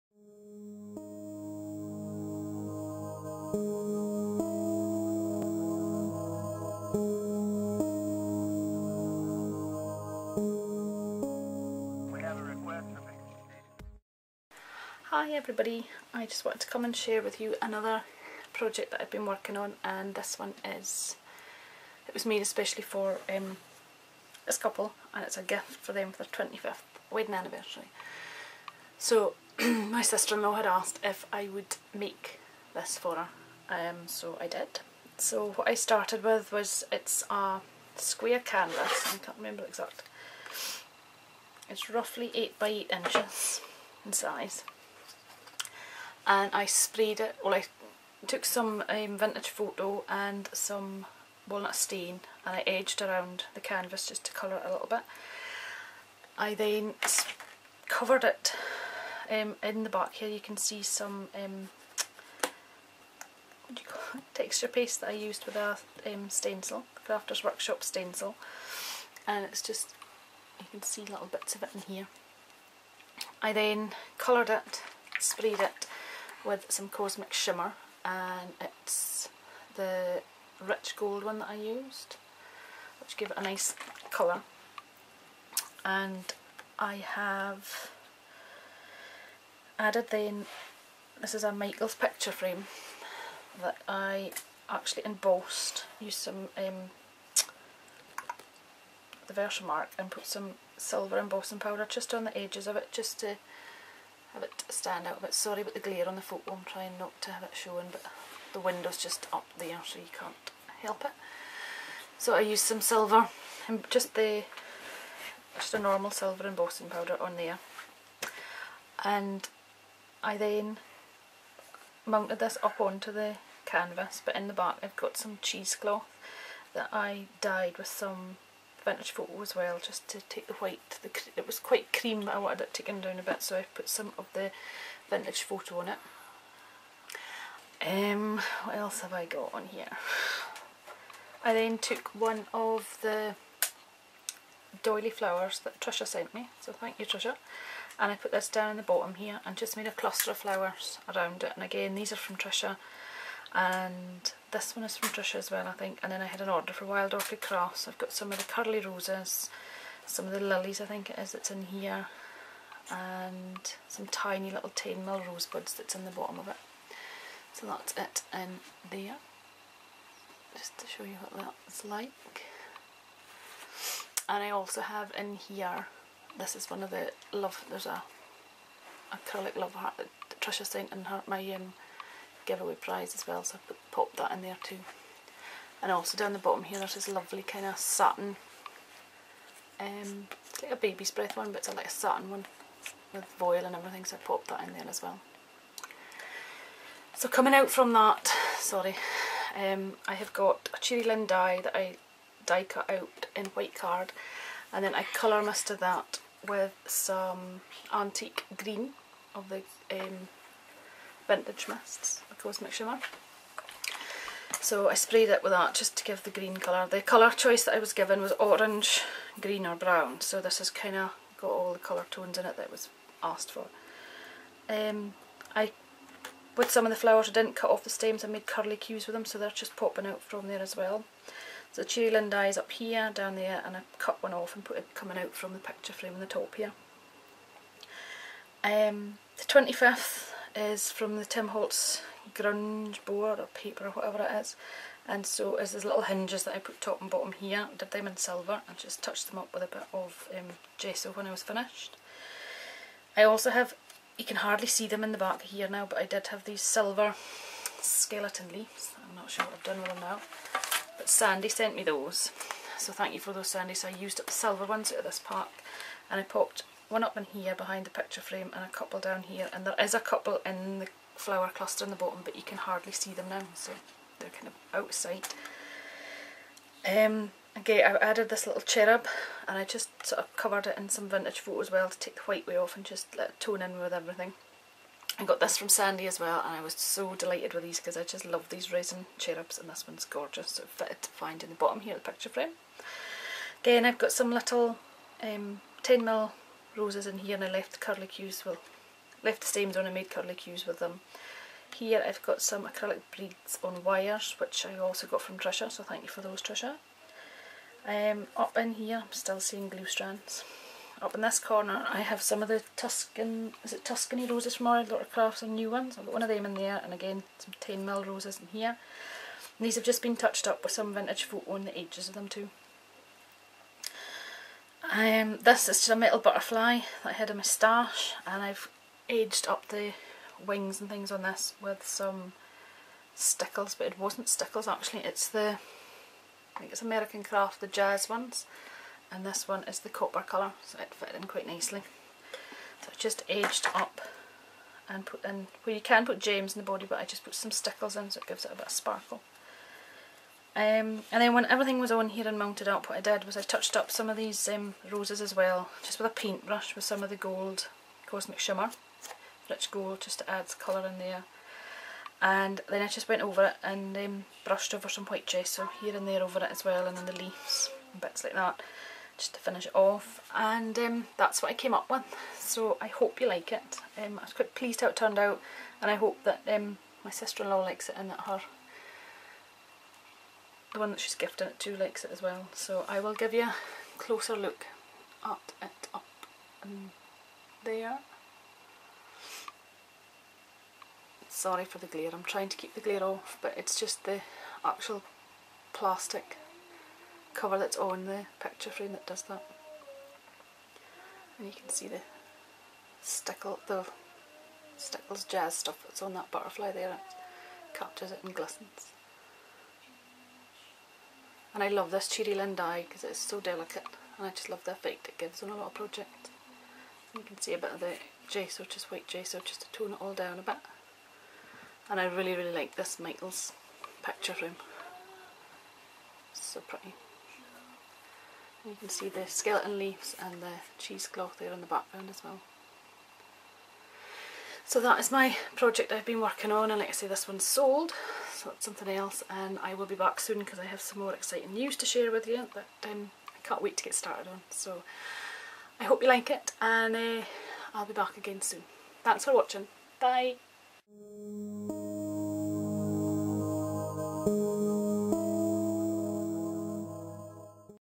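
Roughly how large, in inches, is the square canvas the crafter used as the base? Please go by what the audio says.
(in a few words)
8 by 8 inches.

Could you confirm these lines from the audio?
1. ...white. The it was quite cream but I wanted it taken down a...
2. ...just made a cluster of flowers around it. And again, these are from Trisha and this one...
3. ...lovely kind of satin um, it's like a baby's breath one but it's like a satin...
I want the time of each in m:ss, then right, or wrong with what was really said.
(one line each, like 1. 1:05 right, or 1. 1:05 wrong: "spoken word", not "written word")
1. 2:10 right
2. 2:29 right
3. 3:07 right.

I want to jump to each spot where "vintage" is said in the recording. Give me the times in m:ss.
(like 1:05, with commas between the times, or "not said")
0:49, 2:08, 2:15, 3:31, 4:41, 5:20.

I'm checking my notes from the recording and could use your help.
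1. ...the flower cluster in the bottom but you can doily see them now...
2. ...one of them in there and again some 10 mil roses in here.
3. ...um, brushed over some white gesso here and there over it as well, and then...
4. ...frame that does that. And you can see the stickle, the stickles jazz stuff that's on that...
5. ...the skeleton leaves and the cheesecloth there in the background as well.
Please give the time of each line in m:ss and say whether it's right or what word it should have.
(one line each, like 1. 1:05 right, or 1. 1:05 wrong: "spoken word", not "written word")
1. 4:30 wrong: "hardly", not "doily"
2. 5:16 right
3. 6:03 right
4. 6:38 right
5. 7:09 right.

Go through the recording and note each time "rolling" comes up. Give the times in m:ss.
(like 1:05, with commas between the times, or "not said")
not said.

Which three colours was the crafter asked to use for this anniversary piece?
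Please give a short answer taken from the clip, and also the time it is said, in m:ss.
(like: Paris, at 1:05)
Orange, green or brown, at 3:38.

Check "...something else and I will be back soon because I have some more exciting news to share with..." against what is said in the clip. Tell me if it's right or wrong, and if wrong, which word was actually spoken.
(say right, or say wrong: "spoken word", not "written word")
right.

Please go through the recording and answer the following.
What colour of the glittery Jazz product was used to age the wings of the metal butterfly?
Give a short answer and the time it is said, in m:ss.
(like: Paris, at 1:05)
Copper, at 5:39.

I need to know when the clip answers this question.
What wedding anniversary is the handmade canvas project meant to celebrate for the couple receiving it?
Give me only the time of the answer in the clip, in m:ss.
0:26.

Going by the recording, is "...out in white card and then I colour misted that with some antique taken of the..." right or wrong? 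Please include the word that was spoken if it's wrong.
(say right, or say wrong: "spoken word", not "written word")
wrong: "green", not "taken".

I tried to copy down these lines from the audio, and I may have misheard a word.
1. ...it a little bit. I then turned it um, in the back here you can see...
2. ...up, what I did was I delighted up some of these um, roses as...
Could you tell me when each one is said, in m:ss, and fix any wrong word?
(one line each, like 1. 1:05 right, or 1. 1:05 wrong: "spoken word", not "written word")
1. 0:54 wrong: "covered", not "turned"
2. 5:52 wrong: "touched", not "delighted".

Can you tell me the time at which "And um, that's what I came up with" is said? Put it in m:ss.
6:10.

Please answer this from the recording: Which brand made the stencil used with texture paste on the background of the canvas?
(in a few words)
Crafters Workshop.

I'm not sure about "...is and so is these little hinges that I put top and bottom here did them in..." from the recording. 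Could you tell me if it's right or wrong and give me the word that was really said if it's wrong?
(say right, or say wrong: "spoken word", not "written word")
right.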